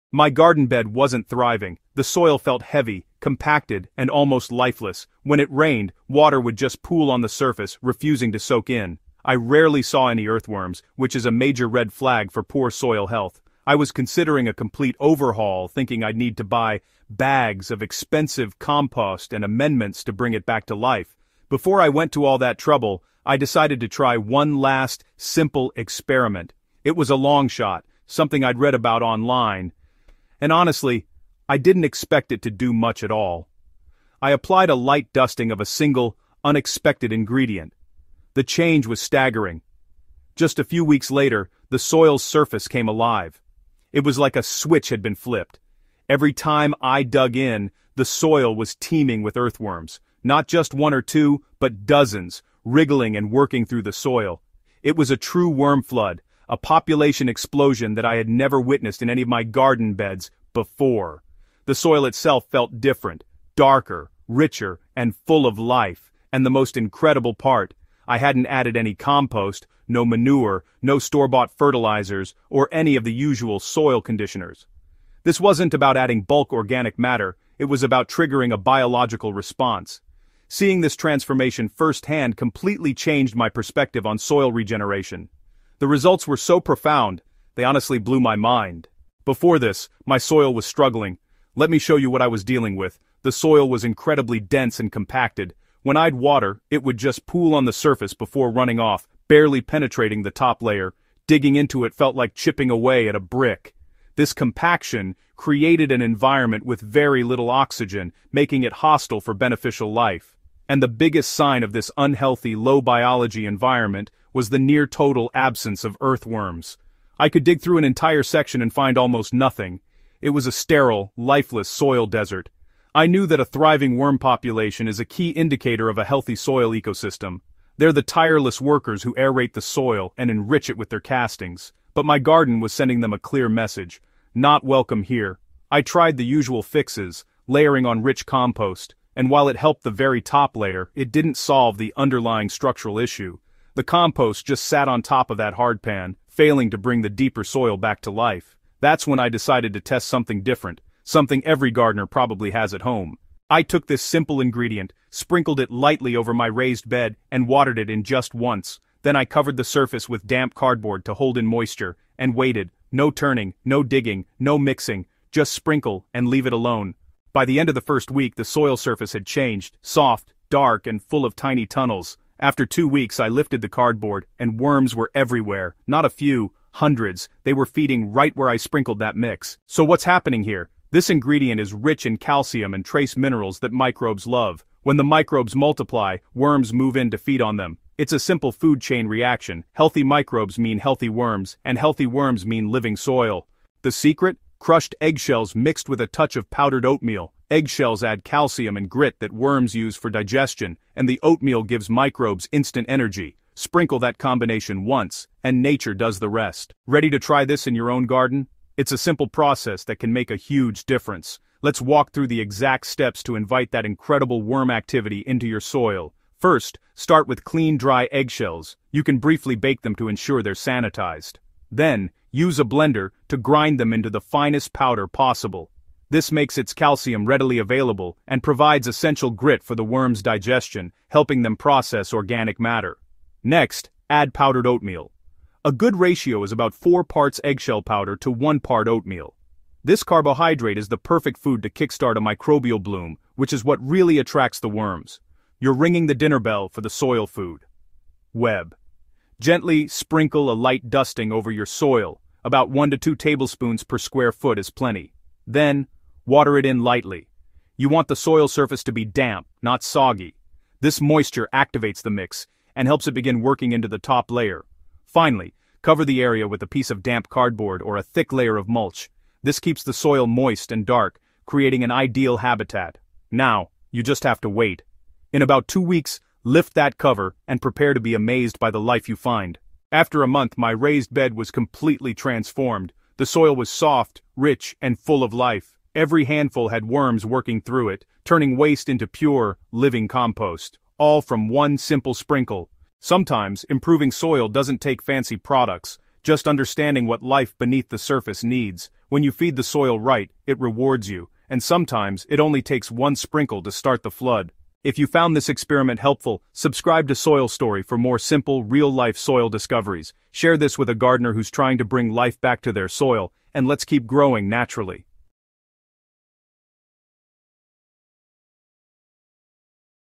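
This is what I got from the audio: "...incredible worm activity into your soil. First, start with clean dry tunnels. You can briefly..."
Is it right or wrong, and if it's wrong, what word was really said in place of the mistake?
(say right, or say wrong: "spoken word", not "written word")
wrong: "eggshells", not "tunnels".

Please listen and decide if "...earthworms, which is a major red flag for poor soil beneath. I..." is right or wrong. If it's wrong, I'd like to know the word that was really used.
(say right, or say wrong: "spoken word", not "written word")
wrong: "health", not "beneath".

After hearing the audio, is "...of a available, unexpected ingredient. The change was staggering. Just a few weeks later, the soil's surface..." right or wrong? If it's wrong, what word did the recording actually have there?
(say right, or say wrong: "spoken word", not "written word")
wrong: "single", not "available".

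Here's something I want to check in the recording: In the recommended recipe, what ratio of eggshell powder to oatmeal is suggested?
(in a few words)
4 to 1.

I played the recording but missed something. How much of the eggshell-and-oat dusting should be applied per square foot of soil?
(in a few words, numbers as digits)
1 to 2 tablespoons.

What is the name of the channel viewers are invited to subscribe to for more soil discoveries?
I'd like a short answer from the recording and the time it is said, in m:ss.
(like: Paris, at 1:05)
Soil Story, at 5:07.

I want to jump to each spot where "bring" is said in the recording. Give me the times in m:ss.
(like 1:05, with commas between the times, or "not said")
0:20, 2:26, 5:11.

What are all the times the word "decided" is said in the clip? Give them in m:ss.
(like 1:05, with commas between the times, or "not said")
0:23, 2:29.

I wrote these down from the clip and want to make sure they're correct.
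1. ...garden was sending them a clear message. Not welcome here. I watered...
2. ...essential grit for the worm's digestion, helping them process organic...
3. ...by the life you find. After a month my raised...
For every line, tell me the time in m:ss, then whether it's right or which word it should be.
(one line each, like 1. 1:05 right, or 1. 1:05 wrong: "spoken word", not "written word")
1. 2:12 wrong: "tried", not "watered"
2. 3:48 right
3. 4:38 right.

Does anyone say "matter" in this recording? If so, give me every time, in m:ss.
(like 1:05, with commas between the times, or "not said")
1:16, 3:52.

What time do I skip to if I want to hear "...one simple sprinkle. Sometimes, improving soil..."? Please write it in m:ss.
4:51.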